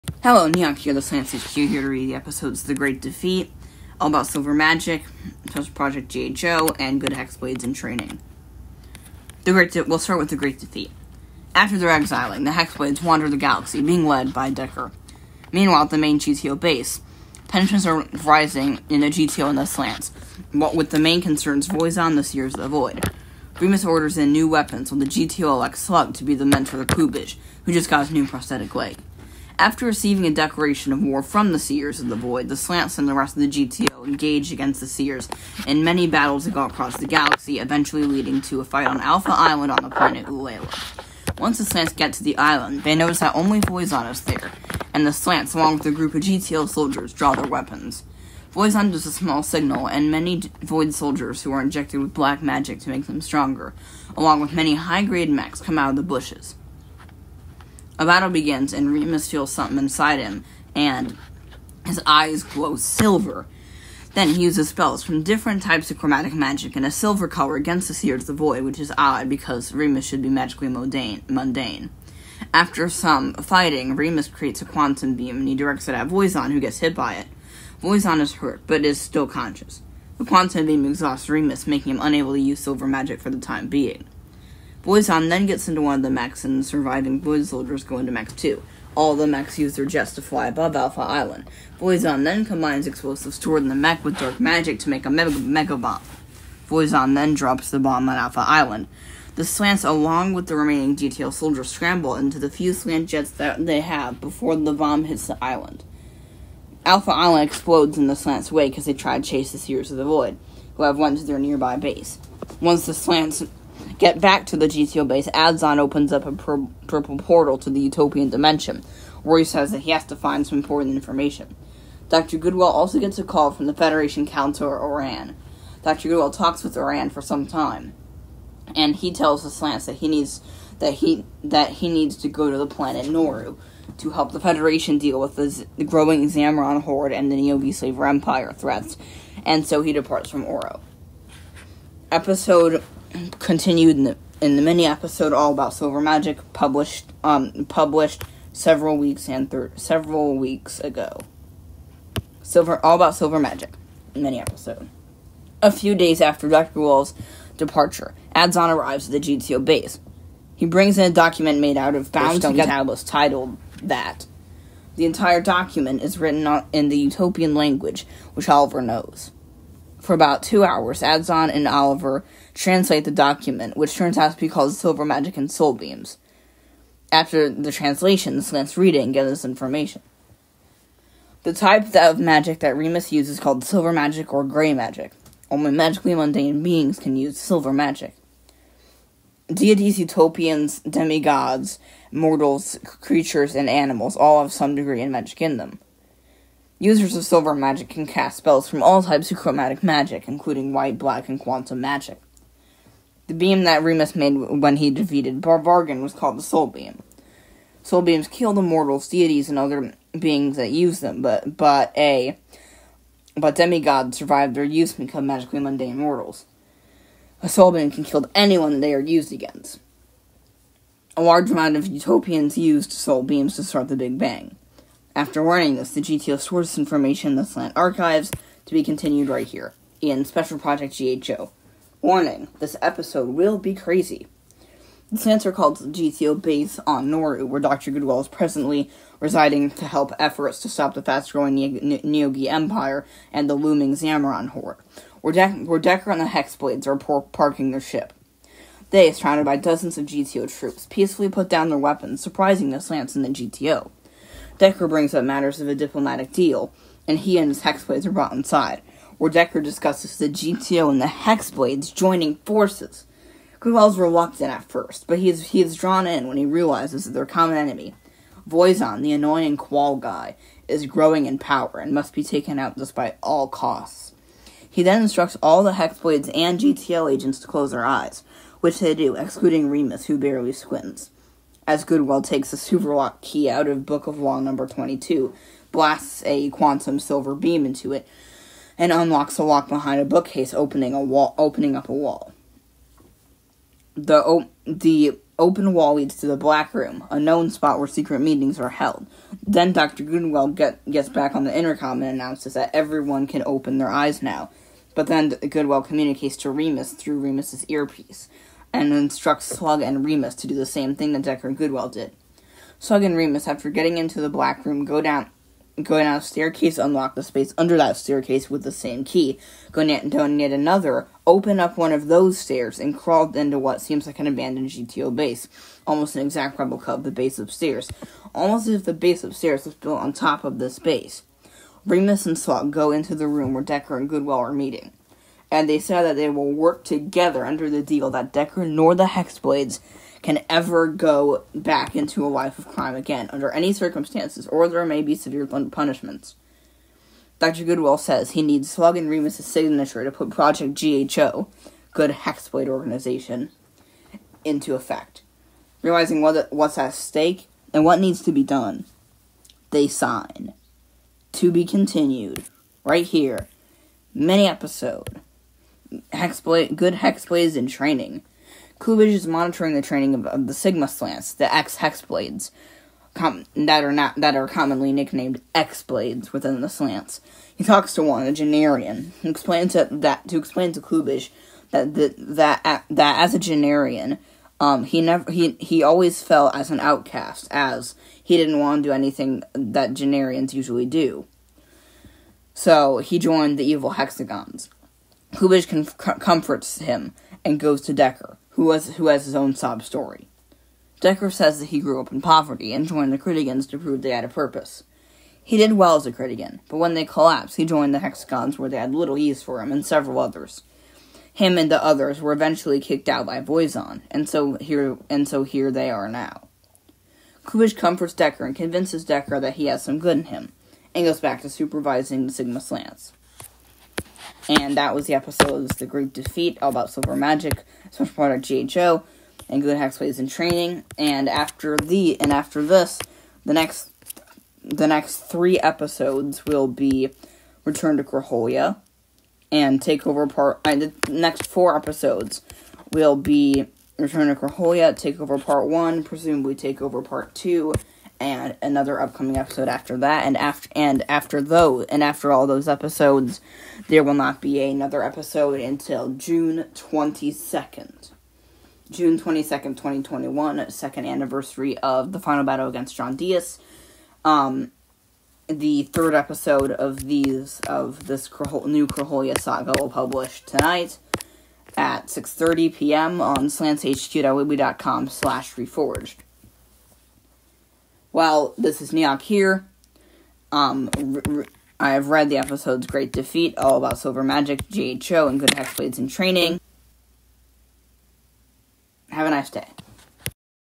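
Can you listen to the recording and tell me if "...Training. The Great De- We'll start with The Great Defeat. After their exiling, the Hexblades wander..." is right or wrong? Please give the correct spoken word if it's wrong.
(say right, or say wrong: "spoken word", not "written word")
right.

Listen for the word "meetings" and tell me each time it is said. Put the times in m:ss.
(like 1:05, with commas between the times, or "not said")
4:58, 5:34.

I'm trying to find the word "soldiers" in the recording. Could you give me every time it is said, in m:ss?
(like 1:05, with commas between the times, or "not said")
0:46, 0:50, 1:27, 1:41.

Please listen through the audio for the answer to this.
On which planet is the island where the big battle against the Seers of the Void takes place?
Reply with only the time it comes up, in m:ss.
0:39.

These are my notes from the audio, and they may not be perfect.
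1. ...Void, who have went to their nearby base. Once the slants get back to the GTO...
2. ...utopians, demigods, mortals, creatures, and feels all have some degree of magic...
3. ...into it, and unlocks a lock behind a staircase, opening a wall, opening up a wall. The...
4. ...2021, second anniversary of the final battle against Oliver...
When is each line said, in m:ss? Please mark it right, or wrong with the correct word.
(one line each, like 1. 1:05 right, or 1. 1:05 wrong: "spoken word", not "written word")
1. 1:50 right
2. 3:09 wrong: "animals", not "feels"
3. 4:47 wrong: "bookcase", not "staircase"
4. 7:39 wrong: "John", not "Oliver".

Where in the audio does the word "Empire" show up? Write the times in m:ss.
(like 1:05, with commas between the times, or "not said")
2:18, 4:02.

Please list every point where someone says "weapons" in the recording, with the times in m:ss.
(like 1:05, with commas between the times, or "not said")
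0:24, 0:47, 4:11.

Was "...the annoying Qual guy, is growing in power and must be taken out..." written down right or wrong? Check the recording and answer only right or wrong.
right.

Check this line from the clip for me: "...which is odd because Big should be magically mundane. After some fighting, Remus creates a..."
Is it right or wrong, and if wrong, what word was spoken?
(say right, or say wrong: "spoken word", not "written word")
wrong: "Remus", not "Big".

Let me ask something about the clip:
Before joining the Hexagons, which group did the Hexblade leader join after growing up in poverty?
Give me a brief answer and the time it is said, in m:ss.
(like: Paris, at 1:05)
the Critigans, at 6:42.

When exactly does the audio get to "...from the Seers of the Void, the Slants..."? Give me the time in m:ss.
0:31.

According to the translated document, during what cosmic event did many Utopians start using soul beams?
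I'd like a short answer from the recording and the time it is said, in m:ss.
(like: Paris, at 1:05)
the Big Bang, at 3:42.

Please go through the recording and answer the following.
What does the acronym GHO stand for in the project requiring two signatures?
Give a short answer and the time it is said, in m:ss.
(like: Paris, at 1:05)
Good Hexblade Organization, at 5:51.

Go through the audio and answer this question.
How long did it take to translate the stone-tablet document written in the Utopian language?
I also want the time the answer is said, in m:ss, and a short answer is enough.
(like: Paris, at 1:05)
about two hours, at 2:50.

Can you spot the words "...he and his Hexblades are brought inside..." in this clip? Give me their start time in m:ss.
4:17.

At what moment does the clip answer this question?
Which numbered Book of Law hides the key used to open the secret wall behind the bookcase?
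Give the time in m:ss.
4:43.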